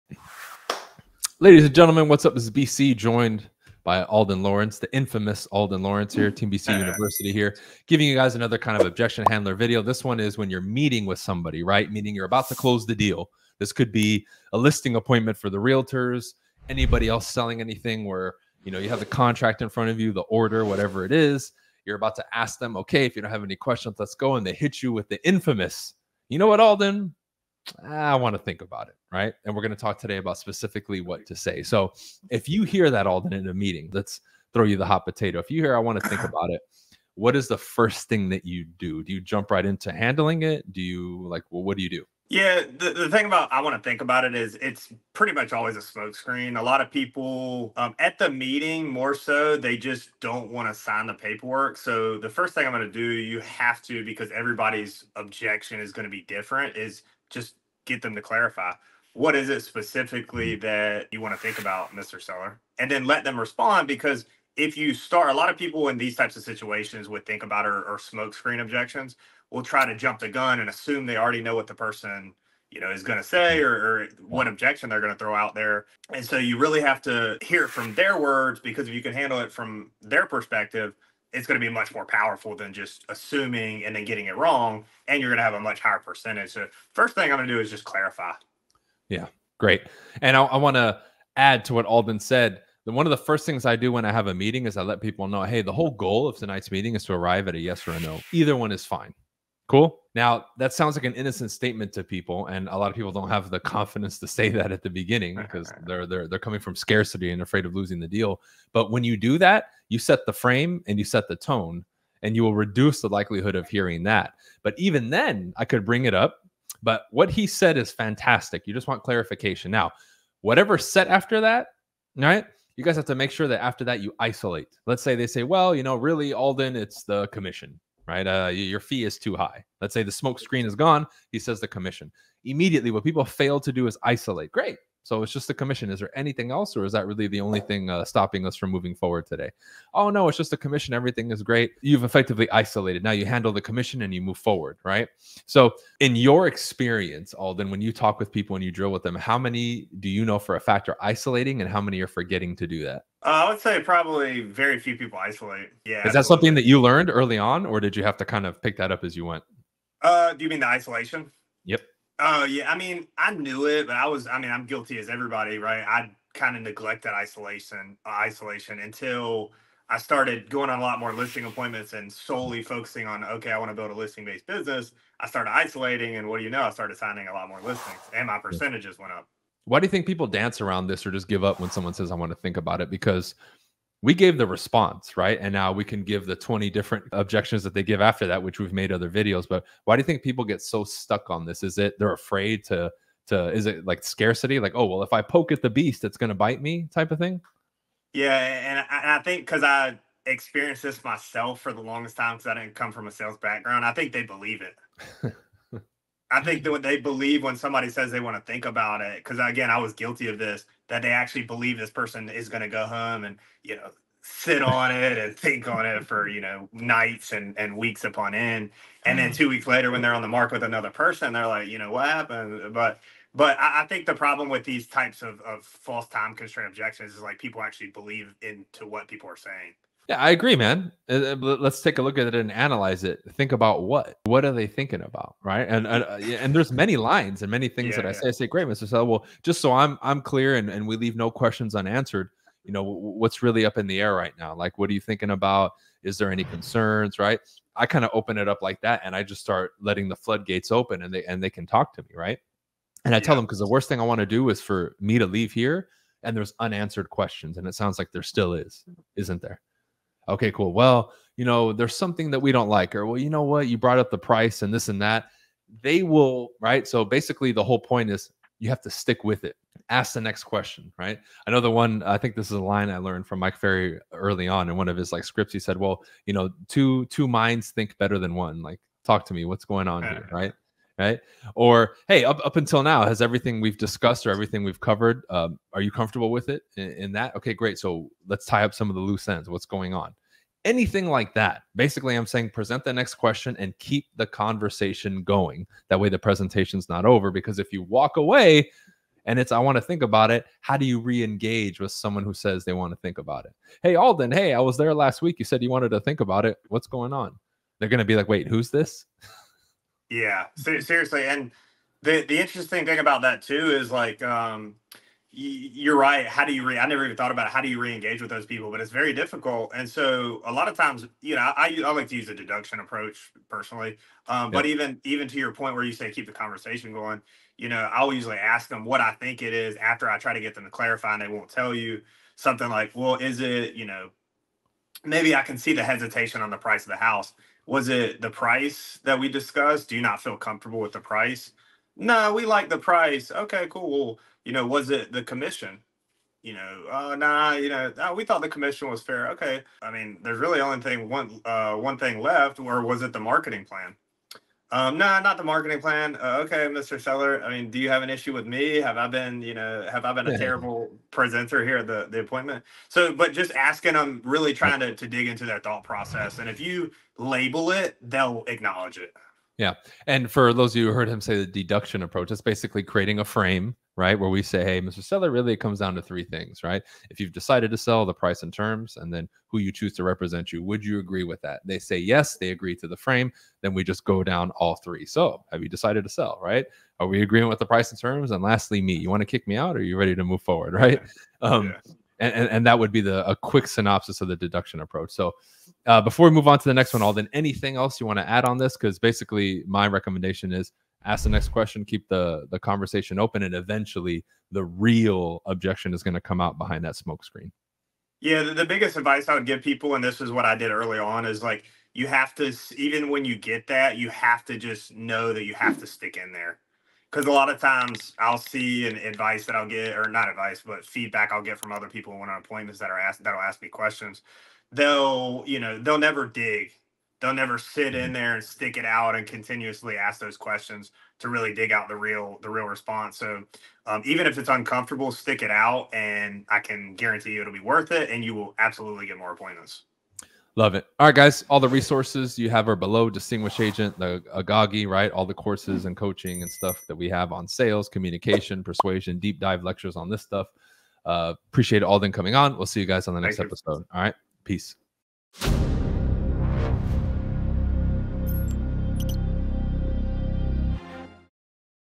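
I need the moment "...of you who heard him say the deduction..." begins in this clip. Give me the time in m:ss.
6:10.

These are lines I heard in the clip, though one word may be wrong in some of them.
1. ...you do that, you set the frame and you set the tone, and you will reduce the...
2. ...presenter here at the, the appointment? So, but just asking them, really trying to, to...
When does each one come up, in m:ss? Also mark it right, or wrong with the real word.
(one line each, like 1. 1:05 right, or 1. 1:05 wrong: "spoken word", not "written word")
1. 1:49 right
2. 6:01 right.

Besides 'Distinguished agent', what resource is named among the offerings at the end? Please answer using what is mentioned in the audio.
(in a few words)
The Agoge.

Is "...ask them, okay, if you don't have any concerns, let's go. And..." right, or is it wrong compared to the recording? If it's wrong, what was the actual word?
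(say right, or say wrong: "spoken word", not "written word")
wrong: "questions", not "concerns".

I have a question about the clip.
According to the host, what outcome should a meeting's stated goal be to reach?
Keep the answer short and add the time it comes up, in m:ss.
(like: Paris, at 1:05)
A yes or a no, at 1:37.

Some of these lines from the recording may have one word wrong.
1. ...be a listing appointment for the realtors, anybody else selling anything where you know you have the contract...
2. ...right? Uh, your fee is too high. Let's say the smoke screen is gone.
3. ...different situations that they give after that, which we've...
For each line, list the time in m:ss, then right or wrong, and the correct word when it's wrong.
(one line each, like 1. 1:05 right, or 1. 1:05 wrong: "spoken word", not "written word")
1. 0:13 right
2. 2:08 right
3. 3:06 wrong: "objections", not "situations".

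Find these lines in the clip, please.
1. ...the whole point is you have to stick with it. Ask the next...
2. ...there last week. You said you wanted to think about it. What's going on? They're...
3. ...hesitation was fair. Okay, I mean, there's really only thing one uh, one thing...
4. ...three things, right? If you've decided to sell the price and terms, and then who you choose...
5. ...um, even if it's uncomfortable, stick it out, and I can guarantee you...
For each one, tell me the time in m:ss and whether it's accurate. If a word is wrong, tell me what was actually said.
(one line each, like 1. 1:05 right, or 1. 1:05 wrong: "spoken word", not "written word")
1. 4:27 right
2. 5:04 right
3. 5:48 wrong: "commission", not "hesitation"
4. 6:16 right
5. 7:13 right.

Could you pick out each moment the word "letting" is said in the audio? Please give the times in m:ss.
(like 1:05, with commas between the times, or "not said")
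4:09.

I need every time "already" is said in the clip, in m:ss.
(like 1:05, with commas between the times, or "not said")
1:11.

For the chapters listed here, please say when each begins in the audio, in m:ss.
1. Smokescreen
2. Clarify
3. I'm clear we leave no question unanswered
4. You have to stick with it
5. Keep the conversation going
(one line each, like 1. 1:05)
1. 0:46
2. 1:27
3. 4:00
4. 4:28
5. 4:53.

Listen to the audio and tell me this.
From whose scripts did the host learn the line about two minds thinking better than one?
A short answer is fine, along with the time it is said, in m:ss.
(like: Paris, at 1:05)
Mike Ferry, at 4:33.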